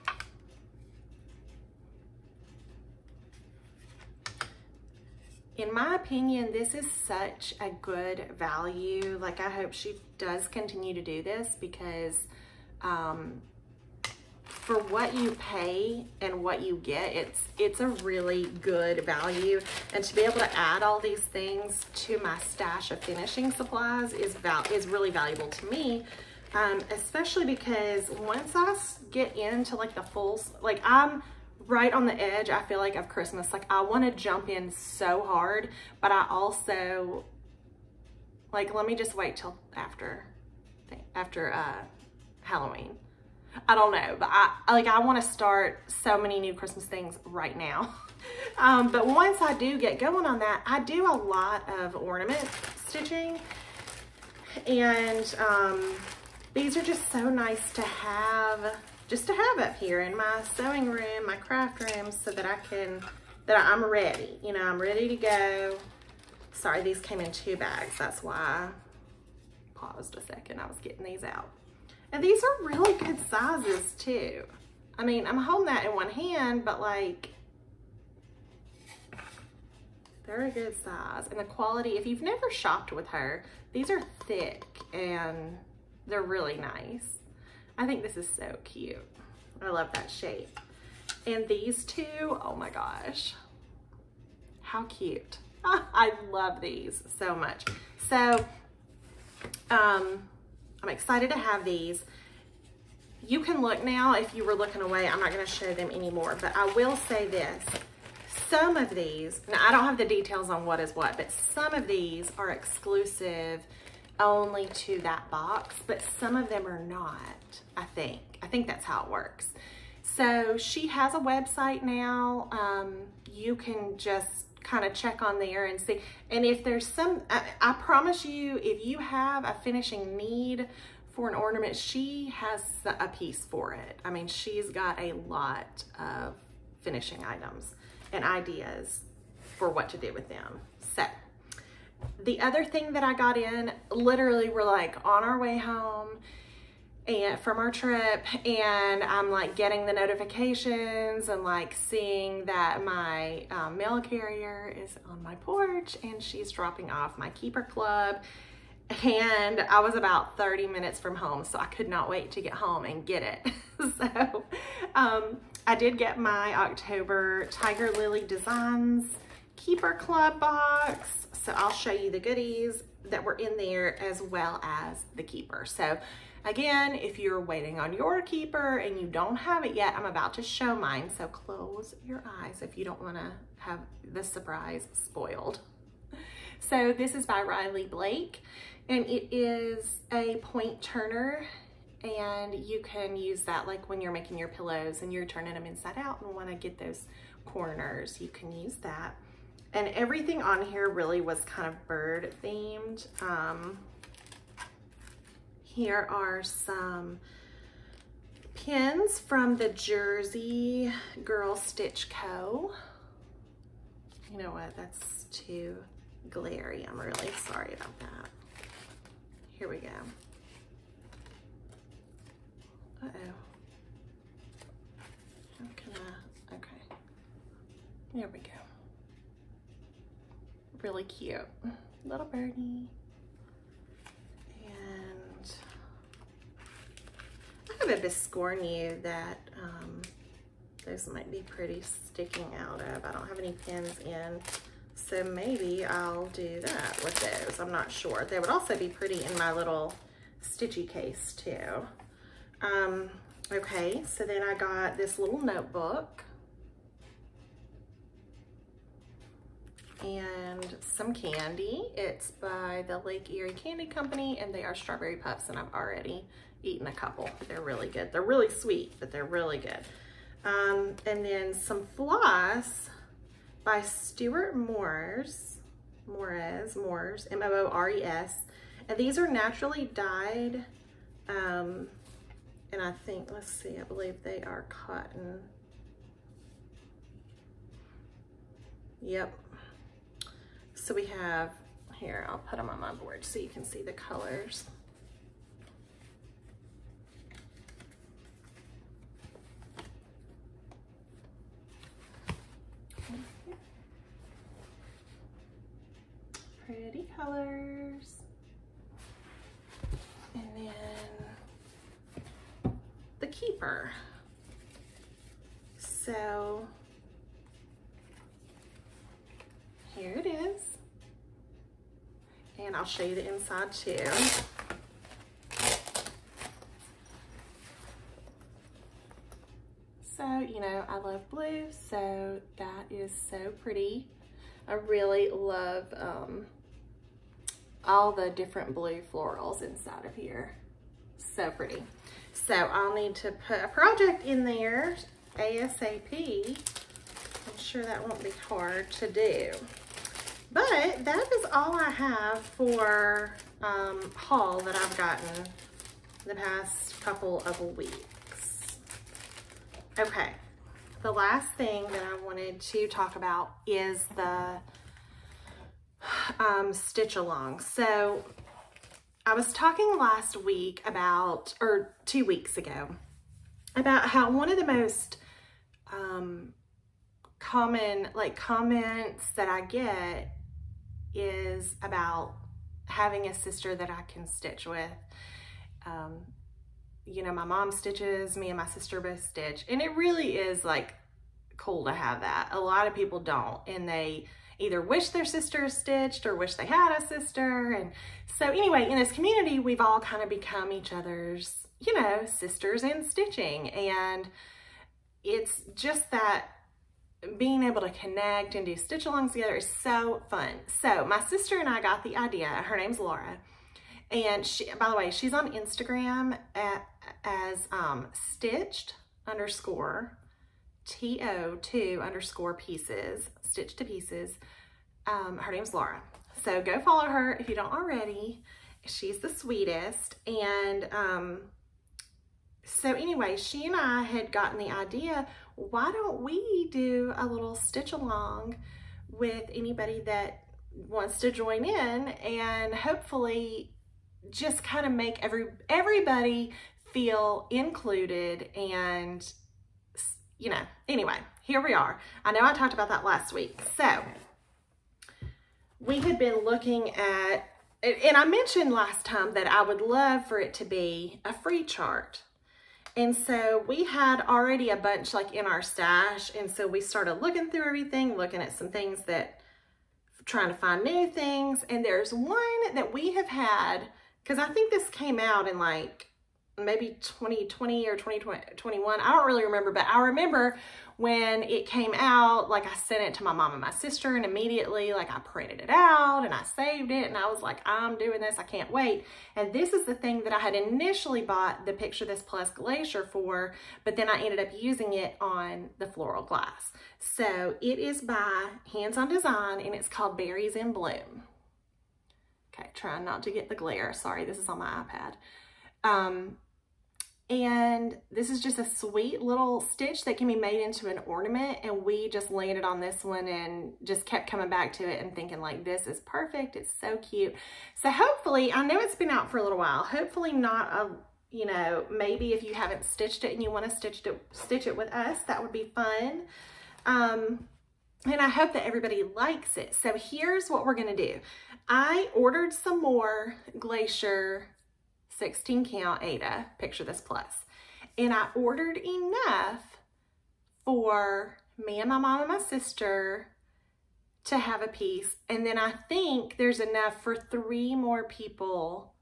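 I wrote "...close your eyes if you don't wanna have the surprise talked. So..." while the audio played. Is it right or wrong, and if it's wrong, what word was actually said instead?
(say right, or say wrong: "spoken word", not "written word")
wrong: "spoiled", not "talked".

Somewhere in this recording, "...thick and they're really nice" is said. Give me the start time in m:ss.
1:24.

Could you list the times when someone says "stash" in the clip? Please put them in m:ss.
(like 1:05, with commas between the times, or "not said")
0:22, 7:45.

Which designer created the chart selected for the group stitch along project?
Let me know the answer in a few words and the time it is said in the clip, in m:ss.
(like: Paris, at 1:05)
Hands on Design, at 8:18.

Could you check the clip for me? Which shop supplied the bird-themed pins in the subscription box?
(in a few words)
Jersey Girl Stitch Co.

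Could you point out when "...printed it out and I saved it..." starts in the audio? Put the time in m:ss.
8:05.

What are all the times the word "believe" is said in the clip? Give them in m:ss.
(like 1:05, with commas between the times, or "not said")
4:43.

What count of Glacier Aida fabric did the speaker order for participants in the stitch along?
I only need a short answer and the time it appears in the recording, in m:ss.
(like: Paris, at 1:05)
16, at 8:55.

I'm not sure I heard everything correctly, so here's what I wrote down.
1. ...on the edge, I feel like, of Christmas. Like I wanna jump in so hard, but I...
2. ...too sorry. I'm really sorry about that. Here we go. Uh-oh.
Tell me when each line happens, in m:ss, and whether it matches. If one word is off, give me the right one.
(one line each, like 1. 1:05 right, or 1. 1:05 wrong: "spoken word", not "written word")
1. 0:31 right
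2. 3:35 wrong: "glary", not "sorry".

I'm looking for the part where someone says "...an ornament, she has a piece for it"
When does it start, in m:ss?
2:11.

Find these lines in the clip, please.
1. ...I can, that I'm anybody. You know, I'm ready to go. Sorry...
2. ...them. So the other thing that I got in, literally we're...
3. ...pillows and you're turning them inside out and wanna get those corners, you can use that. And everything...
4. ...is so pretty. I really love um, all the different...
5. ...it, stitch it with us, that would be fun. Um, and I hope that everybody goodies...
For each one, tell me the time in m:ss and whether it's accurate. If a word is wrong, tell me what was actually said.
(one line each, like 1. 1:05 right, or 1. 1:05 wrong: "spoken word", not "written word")
1. 1:02 wrong: "ready", not "anybody"
2. 2:20 right
3. 3:14 right
4. 5:32 right
5. 8:44 wrong: "likes", not "goodies".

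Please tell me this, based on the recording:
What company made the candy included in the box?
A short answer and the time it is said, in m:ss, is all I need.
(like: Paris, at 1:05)
Lake Erie Candy Company, at 4:22.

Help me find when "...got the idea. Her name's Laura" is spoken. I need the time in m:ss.
6:51.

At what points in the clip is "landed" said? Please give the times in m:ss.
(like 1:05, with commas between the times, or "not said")
8:32.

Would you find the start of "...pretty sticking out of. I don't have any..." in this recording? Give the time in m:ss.
4:01.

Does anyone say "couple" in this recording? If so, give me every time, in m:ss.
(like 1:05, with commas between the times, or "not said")
4:26, 5:57.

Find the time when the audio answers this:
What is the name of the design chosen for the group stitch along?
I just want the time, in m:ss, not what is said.
8:20.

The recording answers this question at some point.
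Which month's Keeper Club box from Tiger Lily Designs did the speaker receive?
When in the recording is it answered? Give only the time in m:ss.
2:46.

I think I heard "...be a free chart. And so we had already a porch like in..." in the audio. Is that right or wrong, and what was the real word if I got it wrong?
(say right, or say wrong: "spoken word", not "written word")
wrong: "bunch", not "porch".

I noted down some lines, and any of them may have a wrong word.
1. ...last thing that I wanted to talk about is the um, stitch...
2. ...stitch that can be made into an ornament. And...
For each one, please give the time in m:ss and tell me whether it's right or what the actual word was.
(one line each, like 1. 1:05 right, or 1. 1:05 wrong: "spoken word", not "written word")
1. 6:01 right
2. 8:29 right.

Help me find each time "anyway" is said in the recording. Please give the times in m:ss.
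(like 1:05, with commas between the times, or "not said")
6:38, 7:12, 7:30.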